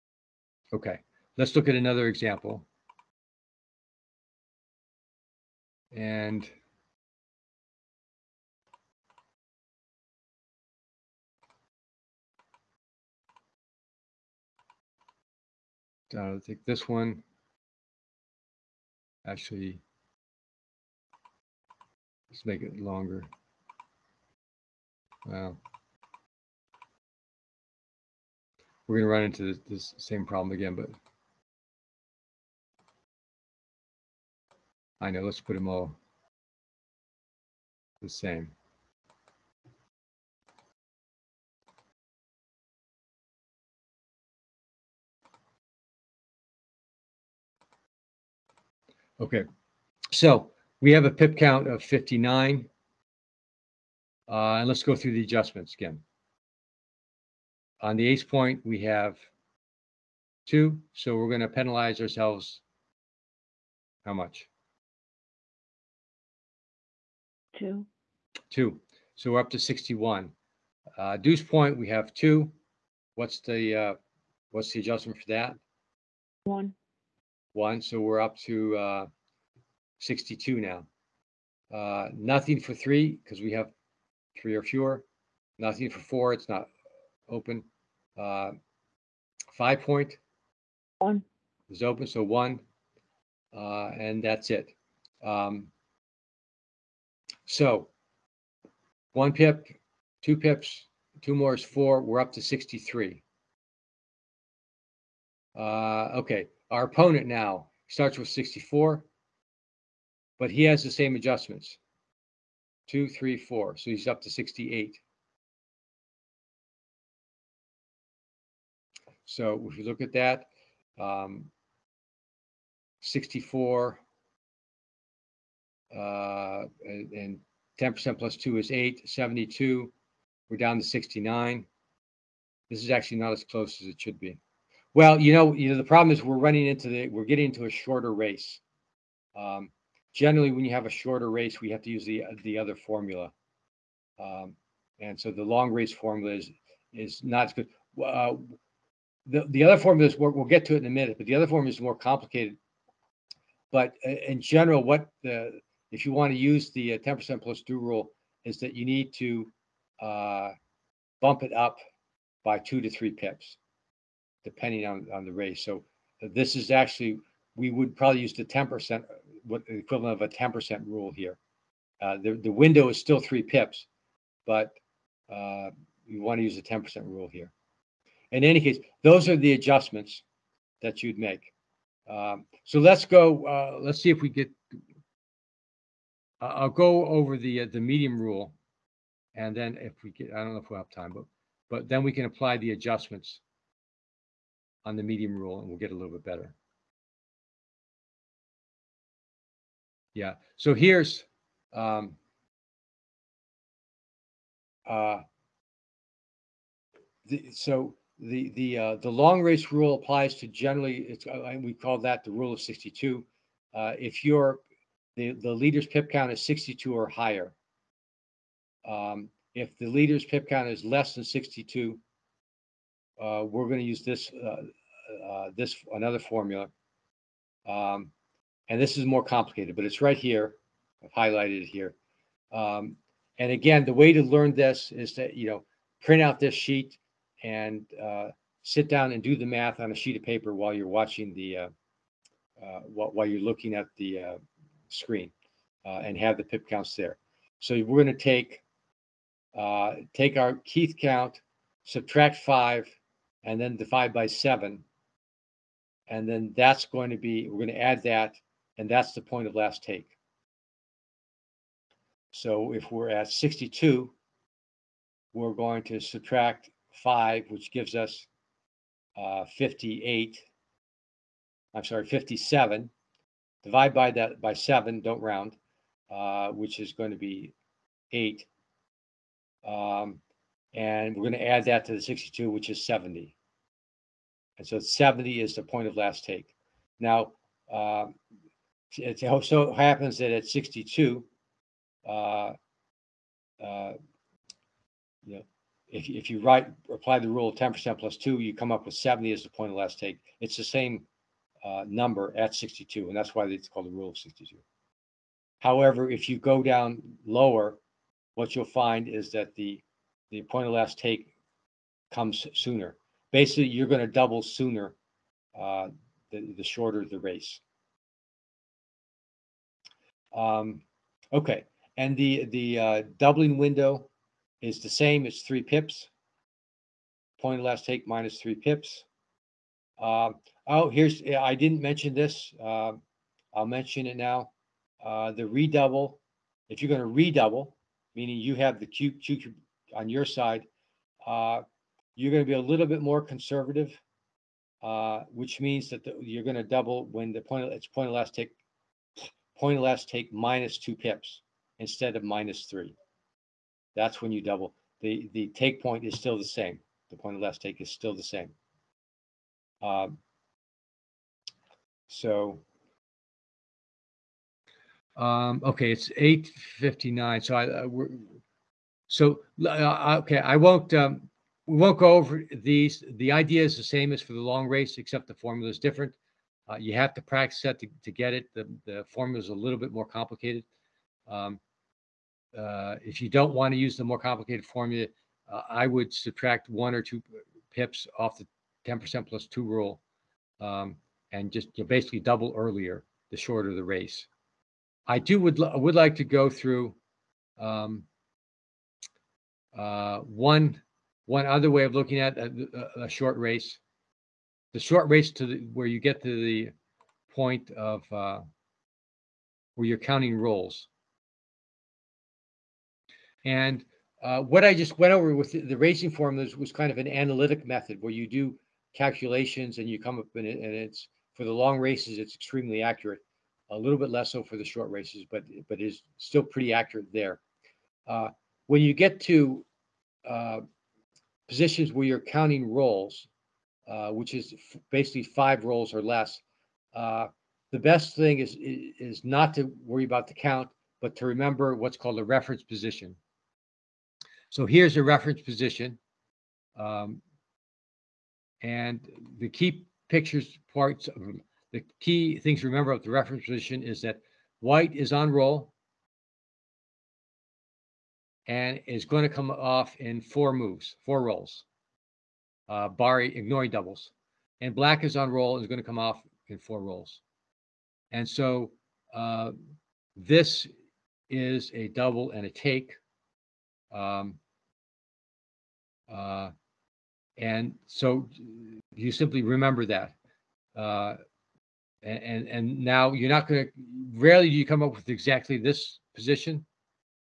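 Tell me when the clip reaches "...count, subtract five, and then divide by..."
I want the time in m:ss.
4:11.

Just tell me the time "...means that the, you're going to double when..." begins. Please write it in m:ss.
5:45.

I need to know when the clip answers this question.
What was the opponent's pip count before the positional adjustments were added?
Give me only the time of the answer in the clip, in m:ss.
1:47.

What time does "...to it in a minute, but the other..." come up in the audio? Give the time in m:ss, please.
2:30.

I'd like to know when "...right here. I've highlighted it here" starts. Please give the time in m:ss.
3:50.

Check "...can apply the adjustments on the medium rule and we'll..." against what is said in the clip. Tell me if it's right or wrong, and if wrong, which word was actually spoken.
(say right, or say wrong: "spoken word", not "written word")
right.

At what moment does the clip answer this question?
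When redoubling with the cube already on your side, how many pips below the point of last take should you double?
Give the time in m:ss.
5:50.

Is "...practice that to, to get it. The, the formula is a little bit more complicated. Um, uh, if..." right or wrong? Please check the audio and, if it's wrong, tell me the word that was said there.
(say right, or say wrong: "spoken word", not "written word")
right.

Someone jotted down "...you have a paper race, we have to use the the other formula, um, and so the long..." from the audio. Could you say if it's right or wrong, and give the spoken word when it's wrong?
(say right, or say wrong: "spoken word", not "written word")
wrong: "shorter", not "paper".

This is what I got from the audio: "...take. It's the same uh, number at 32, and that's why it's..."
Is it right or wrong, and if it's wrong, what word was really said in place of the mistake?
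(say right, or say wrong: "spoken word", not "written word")
wrong: "62", not "32".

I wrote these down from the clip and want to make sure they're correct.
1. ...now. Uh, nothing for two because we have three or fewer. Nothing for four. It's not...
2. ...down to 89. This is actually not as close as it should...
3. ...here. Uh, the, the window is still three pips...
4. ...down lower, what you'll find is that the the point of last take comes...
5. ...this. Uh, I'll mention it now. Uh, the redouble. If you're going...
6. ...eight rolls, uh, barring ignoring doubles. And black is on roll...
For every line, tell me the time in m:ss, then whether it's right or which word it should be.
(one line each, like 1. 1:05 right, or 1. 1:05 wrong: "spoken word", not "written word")
1. 1:20 wrong: "three", not "two"
2. 2:10 wrong: "69", not "89"
3. 2:51 right
4. 5:06 right
5. 5:32 right
6. 7:41 wrong: "four", not "eight".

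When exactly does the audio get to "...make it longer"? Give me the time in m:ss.
0:22.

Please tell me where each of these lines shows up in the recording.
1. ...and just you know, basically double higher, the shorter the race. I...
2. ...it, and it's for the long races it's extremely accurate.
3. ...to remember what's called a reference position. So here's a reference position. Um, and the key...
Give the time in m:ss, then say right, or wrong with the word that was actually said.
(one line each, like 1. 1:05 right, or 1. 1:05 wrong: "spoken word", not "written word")
1. 6:31 wrong: "earlier", not "higher"
2. 7:00 right
3. 7:21 right.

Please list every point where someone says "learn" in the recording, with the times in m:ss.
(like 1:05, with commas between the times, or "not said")
3:54.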